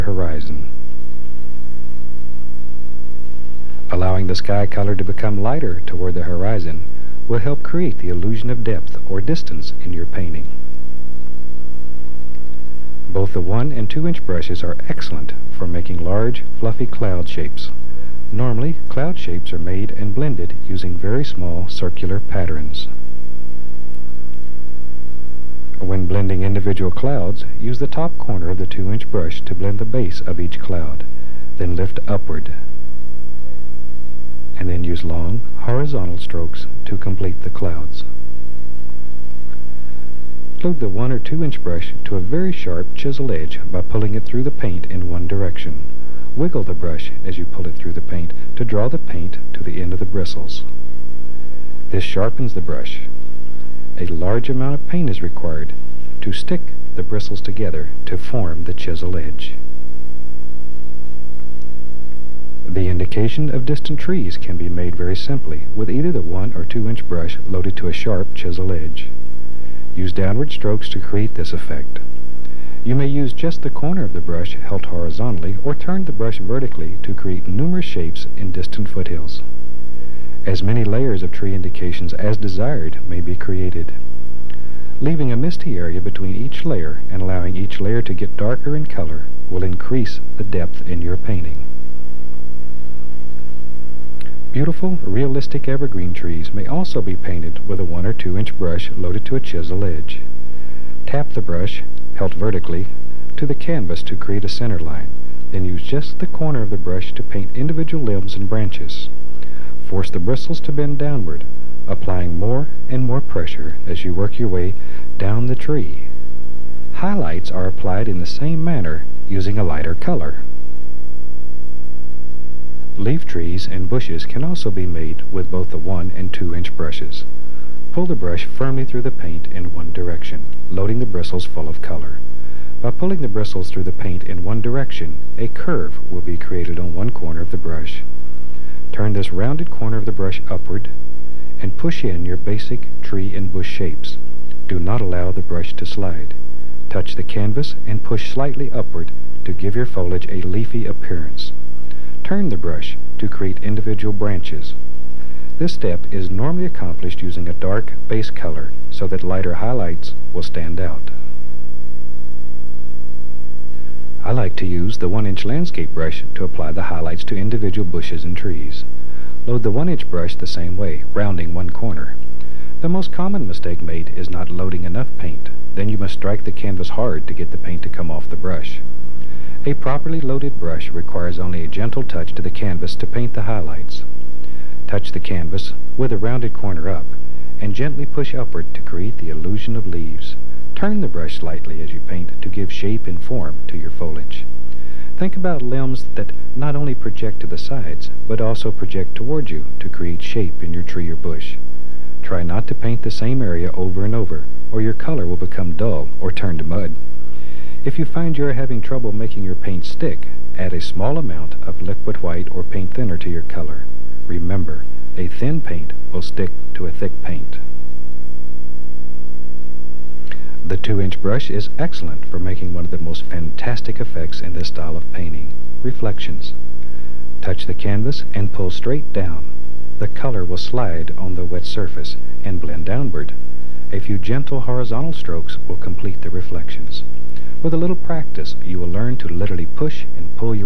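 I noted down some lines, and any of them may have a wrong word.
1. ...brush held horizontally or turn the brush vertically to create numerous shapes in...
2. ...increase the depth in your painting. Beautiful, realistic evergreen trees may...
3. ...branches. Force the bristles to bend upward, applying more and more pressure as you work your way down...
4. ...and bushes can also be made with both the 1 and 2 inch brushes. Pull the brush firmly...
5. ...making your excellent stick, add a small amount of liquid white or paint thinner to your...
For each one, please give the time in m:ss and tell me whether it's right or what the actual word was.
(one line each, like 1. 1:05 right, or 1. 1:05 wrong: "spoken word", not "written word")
1. 1:14 right
2. 1:29 right
3. 1:48 wrong: "downward", not "upward"
4. 2:03 right
5. 3:29 wrong: "paint", not "excellent".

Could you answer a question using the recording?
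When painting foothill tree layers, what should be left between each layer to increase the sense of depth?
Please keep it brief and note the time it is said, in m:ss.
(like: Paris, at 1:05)
misty area, at 1:25.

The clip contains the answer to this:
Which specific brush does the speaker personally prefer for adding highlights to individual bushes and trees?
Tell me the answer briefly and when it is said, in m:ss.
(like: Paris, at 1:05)
1-inch landscape brush, at 2:45.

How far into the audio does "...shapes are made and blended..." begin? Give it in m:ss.
0:19.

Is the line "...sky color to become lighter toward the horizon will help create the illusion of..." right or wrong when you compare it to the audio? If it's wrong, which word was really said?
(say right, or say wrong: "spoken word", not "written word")
right.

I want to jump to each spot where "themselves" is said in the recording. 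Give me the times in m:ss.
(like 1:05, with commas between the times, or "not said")
not said.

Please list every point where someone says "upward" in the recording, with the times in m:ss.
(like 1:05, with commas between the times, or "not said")
0:32, 2:20, 2:28, 3:08.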